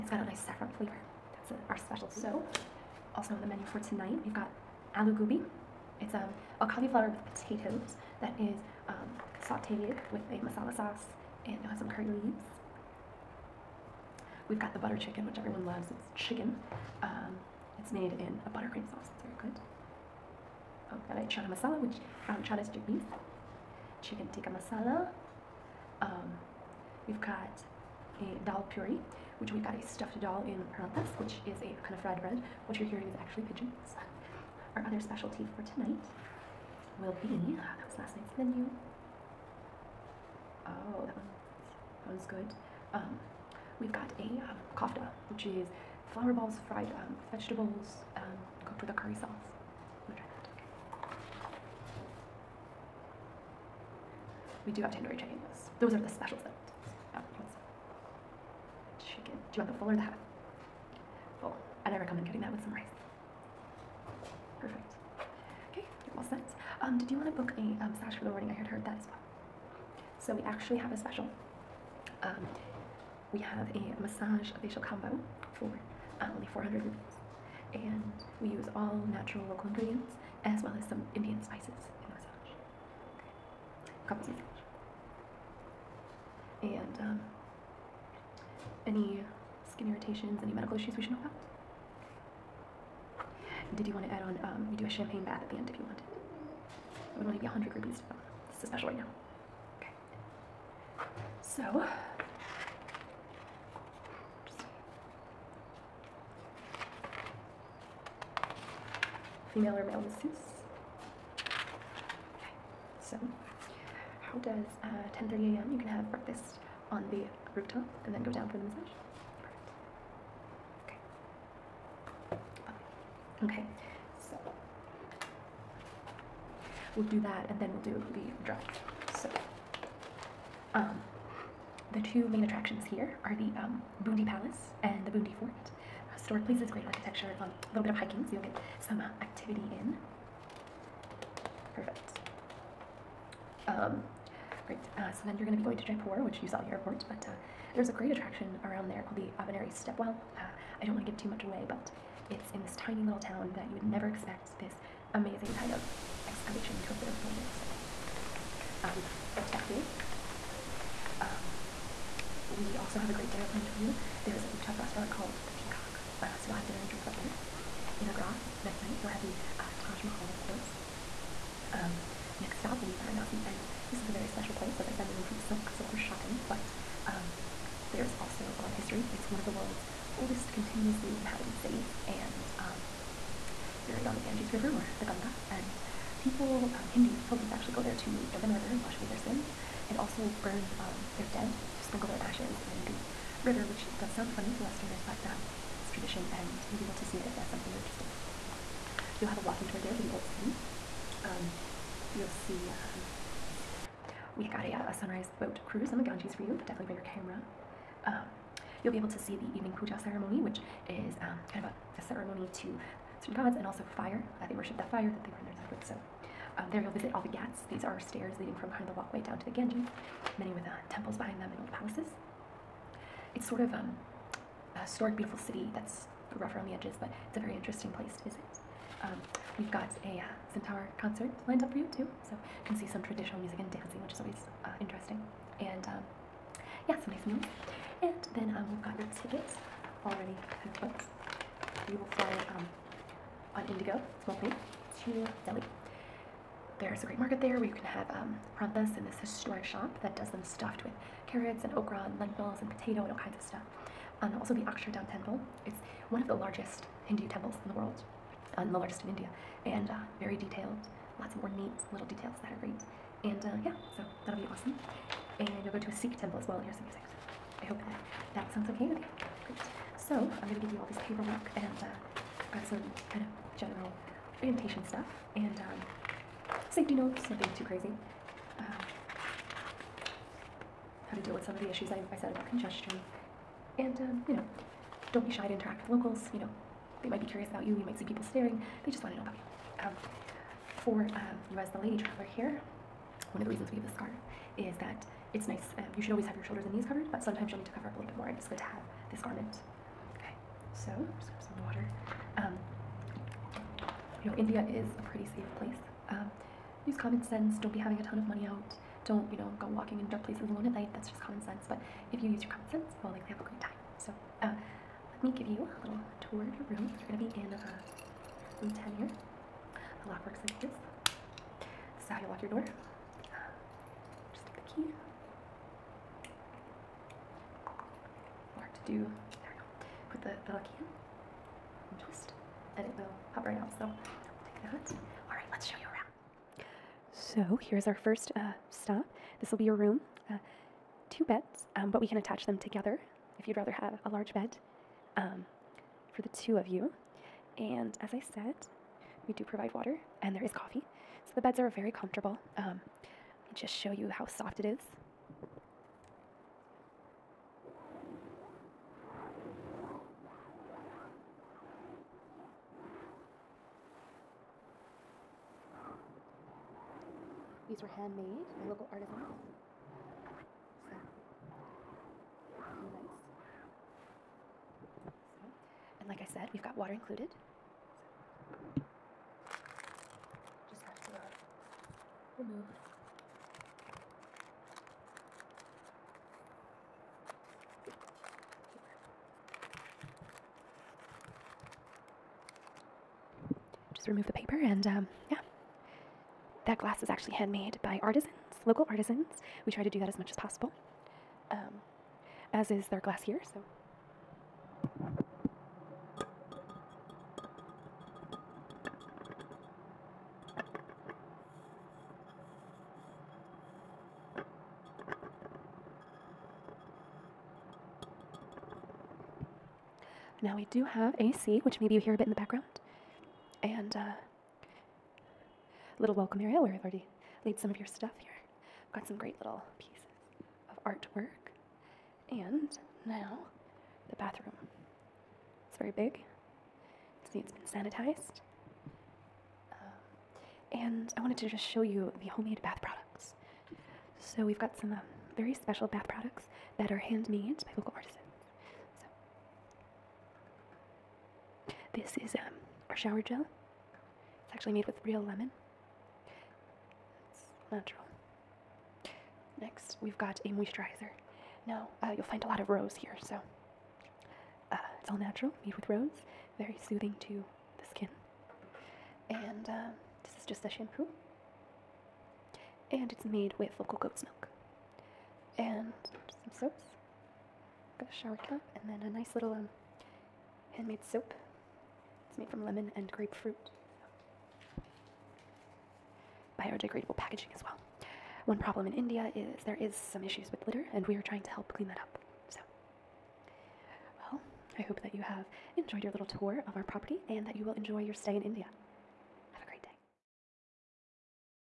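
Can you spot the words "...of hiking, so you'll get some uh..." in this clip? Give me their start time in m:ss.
2:17.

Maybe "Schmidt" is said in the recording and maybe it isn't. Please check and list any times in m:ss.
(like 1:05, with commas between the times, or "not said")
not said.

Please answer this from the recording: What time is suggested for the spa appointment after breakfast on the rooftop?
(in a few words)
10:30 a.m.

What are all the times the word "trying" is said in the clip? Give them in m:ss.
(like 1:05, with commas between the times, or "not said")
8:11.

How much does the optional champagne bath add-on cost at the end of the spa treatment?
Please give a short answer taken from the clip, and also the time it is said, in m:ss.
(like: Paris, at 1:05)
100 rupees, at 1:37.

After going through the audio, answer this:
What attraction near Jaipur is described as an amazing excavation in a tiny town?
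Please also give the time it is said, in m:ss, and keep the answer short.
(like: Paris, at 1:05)
Abhaneri Stepwell, at 2:29.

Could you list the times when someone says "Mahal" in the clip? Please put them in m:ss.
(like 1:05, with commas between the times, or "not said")
2:50.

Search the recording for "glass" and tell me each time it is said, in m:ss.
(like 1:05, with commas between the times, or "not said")
6:36, 6:43.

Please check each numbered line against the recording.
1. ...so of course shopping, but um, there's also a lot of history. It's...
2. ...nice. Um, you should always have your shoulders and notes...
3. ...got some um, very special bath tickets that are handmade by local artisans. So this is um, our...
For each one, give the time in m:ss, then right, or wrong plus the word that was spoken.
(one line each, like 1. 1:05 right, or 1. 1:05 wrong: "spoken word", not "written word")
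1. 2:55 right
2. 4:55 wrong: "knees", not "notes"
3. 7:24 wrong: "products", not "tickets".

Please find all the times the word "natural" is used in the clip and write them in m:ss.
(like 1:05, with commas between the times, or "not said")
1:19, 7:37, 7:45.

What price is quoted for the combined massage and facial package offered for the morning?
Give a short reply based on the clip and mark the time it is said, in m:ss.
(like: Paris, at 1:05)
400 rupees, at 1:16.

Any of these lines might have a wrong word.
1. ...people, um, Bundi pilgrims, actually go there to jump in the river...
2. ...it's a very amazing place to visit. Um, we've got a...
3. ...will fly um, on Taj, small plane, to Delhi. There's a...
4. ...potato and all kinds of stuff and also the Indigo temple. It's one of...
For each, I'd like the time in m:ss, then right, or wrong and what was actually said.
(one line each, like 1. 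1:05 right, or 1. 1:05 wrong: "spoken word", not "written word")
1. 3:06 wrong: "Hindu", not "Bundi"
2. 3:47 wrong: "interesting", not "amazing"
3. 4:01 wrong: "Indigo", not "Taj"
4. 4:12 wrong: "Akshardham", not "Indigo".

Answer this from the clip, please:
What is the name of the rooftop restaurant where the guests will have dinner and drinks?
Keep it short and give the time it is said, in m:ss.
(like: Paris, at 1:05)
The Peacock, at 2:45.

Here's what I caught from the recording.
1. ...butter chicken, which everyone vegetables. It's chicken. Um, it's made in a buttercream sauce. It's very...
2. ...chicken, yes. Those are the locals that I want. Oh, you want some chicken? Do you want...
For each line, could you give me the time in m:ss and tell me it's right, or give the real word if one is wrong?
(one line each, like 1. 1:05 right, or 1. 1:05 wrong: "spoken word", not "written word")
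1. 0:14 wrong: "loves", not "vegetables"
2. 0:55 wrong: "specials", not "locals".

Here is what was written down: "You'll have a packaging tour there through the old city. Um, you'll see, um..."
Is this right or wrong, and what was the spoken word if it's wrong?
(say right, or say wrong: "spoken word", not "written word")
wrong: "walking", not "packaging".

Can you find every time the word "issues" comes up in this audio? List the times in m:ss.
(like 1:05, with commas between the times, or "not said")
1:30, 4:41, 8:10.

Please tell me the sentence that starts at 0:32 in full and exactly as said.
What you're hearing is actually pigeons.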